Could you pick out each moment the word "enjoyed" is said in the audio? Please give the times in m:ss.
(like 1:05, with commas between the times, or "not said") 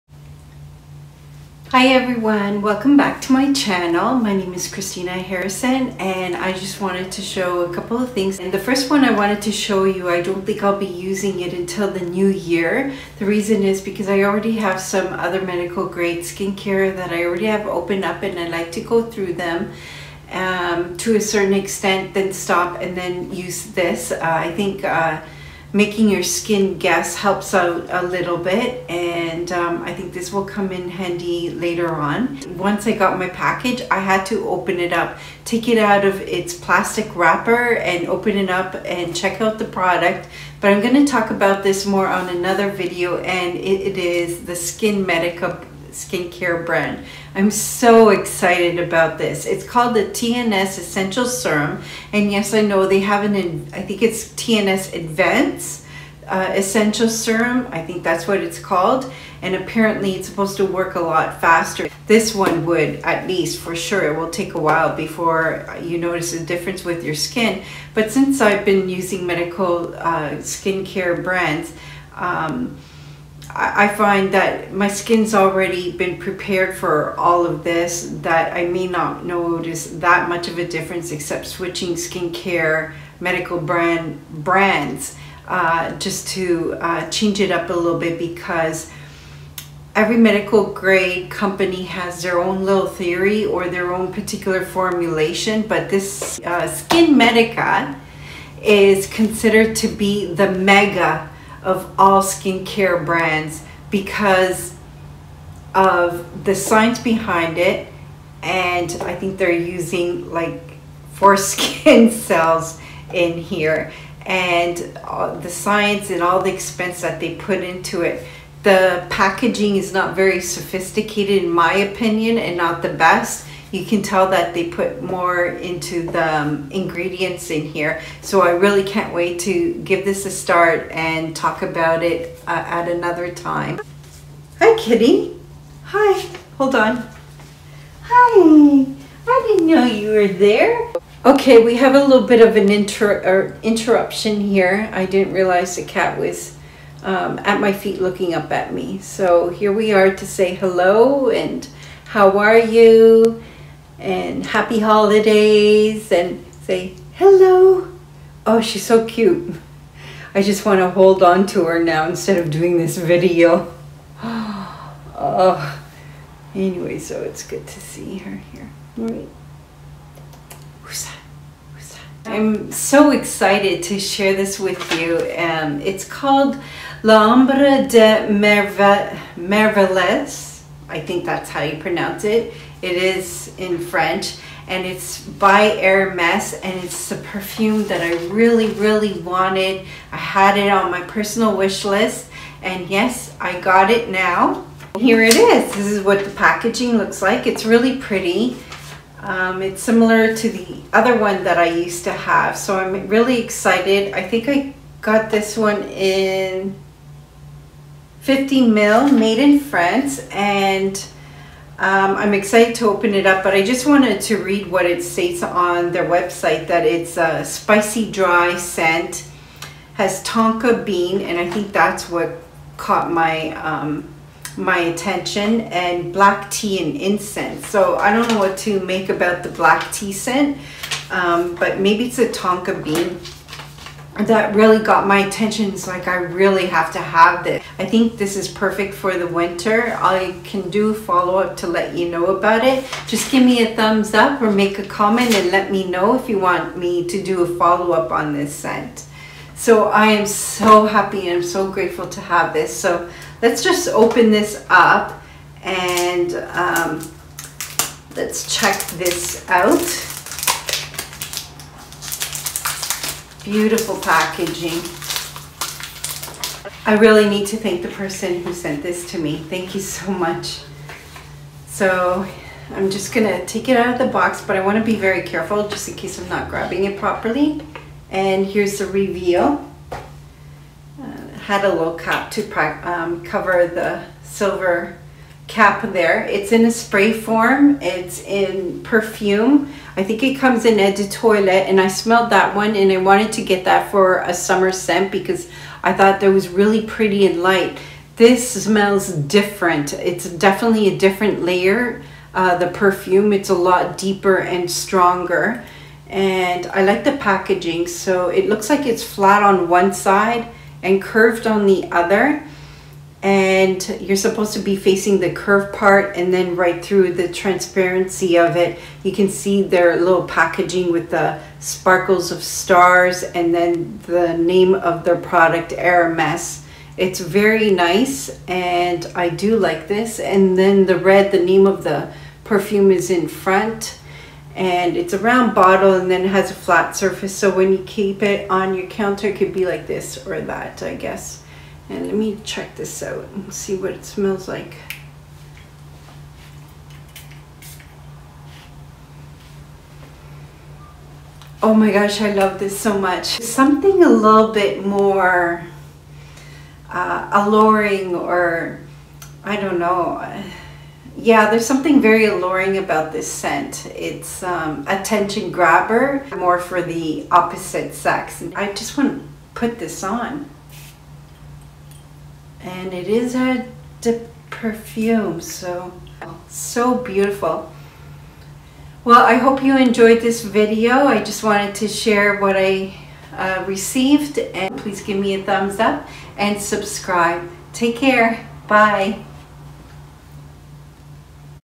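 6:19.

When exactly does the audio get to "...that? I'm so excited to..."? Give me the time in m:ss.
2:51.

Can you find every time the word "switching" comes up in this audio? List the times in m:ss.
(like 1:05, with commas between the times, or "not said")
1:21.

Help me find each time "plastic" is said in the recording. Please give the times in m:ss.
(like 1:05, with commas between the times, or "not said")
0:36.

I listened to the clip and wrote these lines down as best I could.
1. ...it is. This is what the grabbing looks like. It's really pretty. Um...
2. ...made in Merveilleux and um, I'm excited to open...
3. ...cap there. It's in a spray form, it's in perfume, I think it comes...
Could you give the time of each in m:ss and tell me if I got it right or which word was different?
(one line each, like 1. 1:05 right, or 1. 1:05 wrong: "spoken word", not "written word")
1. 3:15 wrong: "packaging", not "grabbing"
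2. 3:29 wrong: "France", not "Merveilleux"
3. 4:45 right.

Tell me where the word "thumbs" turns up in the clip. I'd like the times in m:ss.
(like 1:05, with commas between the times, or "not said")
4:03, 6:25.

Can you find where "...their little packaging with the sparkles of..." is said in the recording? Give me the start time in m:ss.
5:19.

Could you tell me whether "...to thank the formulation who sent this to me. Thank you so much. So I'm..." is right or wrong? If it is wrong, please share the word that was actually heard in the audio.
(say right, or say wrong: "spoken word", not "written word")
wrong: "person", not "formulation".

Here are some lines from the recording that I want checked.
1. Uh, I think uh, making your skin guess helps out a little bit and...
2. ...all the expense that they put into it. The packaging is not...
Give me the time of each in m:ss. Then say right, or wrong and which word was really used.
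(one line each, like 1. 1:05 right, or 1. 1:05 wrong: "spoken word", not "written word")
1. 0:24 right
2. 1:56 right.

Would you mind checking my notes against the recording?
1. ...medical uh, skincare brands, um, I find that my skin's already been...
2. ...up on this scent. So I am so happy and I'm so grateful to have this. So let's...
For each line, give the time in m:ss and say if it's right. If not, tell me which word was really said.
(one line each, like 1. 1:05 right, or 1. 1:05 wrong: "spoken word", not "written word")
1. 1:09 right
2. 4:07 right.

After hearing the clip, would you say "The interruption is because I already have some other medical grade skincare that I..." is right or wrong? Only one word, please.
wrong.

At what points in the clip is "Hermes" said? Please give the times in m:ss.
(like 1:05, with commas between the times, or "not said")
3:05, 5:25.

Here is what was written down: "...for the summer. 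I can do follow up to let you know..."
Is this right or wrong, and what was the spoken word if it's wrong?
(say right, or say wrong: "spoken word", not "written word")
wrong: "winter", not "summer".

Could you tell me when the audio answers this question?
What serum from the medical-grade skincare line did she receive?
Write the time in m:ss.
0:50.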